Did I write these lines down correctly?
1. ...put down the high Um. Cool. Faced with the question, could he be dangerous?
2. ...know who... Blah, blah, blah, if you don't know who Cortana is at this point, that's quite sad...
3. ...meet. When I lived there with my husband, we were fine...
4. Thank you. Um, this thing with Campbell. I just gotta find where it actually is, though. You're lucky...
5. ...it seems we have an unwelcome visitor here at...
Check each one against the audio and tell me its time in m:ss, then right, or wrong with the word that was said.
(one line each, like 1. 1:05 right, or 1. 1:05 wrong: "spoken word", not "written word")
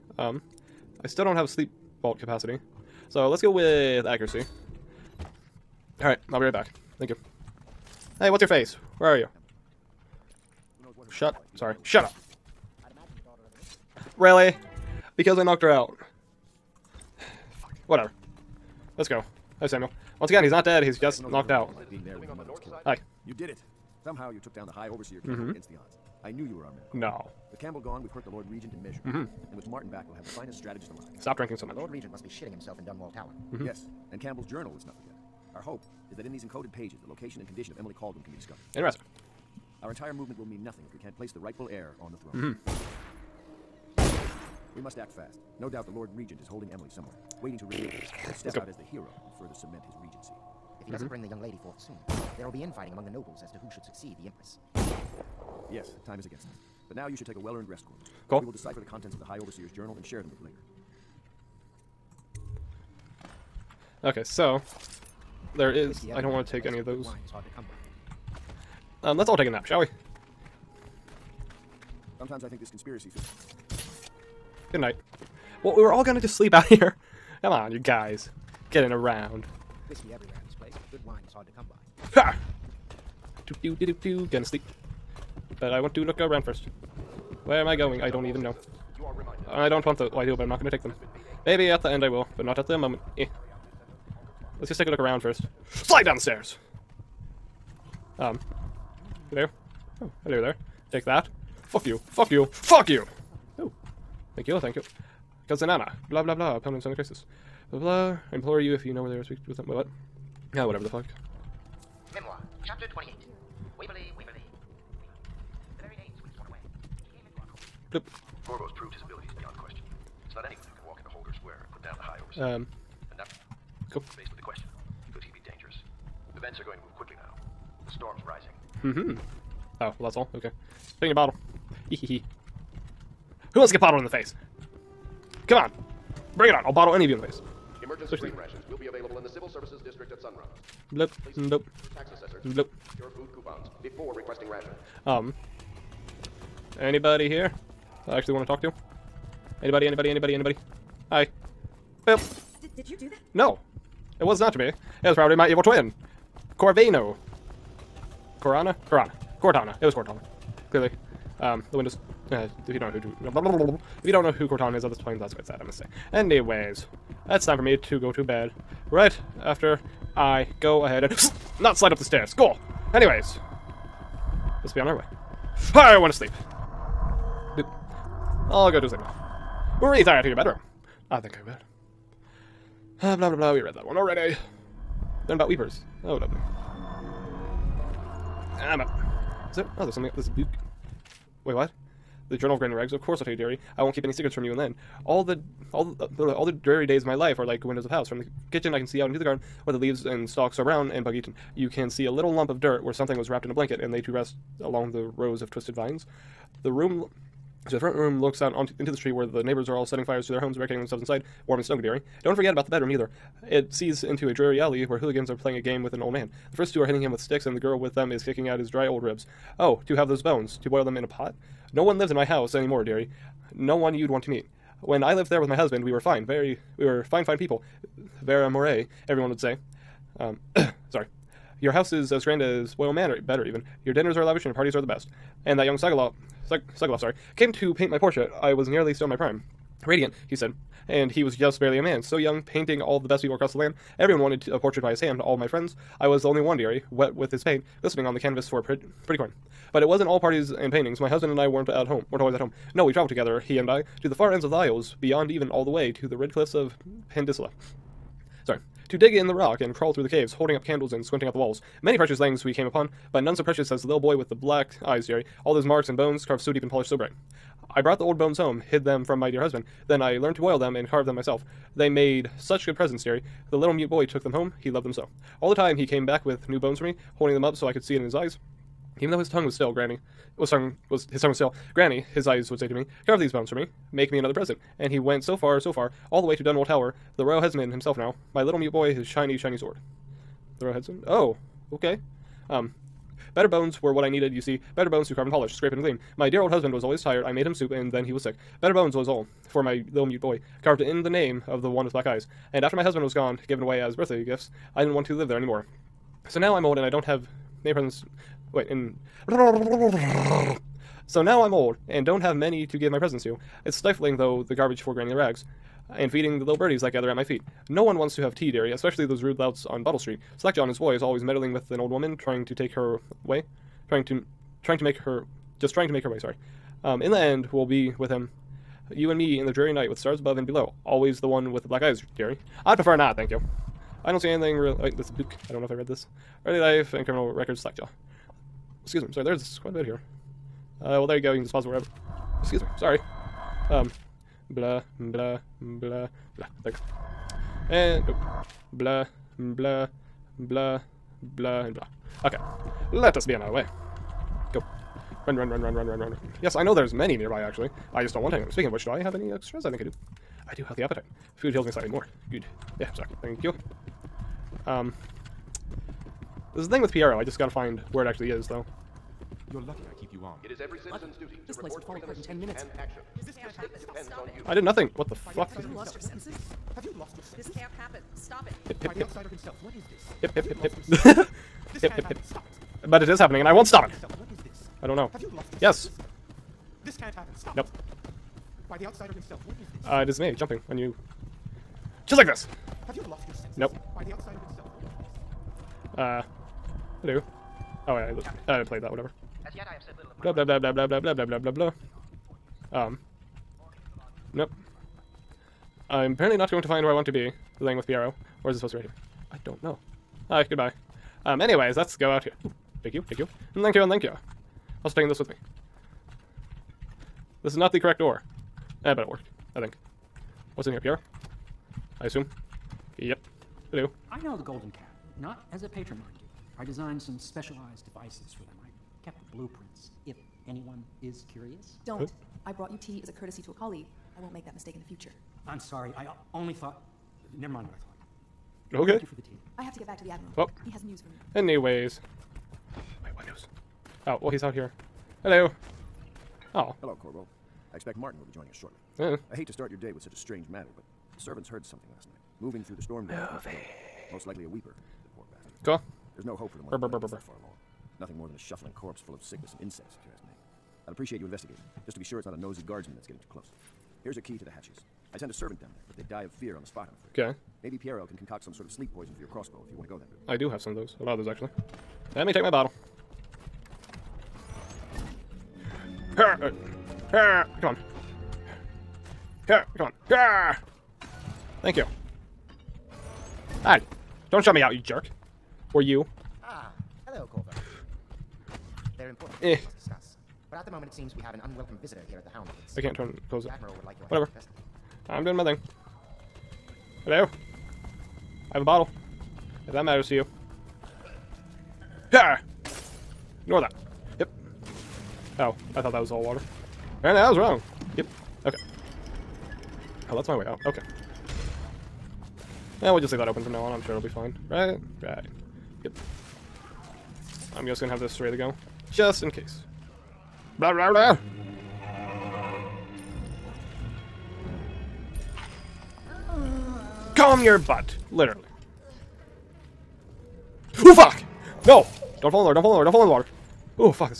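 1. 2:01 right
2. 2:42 right
3. 3:44 right
4. 6:03 wrong: "Piero", not "Campbell"
5. 8:10 right.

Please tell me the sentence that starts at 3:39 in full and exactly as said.
Oh, to have those bones, to boil them in a pot?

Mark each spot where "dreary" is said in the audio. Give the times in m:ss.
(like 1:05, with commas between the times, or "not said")
3:16, 3:34, 5:29.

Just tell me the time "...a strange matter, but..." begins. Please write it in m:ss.
7:30.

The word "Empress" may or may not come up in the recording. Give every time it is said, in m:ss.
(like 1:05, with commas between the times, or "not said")
0:54.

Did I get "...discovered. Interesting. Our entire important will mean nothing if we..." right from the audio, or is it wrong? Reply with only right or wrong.
wrong.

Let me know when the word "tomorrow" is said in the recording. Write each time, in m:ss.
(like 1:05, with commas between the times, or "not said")
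not said.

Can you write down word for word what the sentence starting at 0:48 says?
Step out as the hero and further cement his regency he doesn't mm -hmm.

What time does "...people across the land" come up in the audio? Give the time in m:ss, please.
4:03.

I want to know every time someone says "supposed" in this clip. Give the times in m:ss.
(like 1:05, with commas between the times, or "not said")
6:48.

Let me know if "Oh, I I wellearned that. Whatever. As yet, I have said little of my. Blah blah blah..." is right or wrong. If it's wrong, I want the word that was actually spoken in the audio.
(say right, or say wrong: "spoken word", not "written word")
wrong: "played", not "wellearned".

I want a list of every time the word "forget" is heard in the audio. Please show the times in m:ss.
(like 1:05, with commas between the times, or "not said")
0:34, 3:32.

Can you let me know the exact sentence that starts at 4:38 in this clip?
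Even though his tongue was still, Granny was tongue was his tongue was still.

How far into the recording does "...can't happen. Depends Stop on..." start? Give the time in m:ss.
6:13.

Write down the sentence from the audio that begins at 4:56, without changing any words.
My dear old husband was always tired, I made him soup, and then he was sick.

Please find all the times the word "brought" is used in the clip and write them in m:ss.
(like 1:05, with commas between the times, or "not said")
4:27, 7:12.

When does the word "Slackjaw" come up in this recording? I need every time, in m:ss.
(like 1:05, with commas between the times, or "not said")
5:20, 5:37.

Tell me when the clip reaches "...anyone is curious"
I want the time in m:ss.
7:10.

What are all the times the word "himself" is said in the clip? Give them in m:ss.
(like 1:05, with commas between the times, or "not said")
0:32, 4:47, 6:19, 6:29, 6:34.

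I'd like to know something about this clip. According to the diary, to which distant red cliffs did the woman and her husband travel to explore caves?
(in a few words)
Pandisla.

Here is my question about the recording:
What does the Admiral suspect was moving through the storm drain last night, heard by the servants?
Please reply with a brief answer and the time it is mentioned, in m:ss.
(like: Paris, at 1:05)
a weeper, at 7:34.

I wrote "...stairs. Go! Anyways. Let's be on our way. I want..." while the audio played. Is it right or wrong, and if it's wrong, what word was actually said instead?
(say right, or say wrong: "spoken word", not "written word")
right.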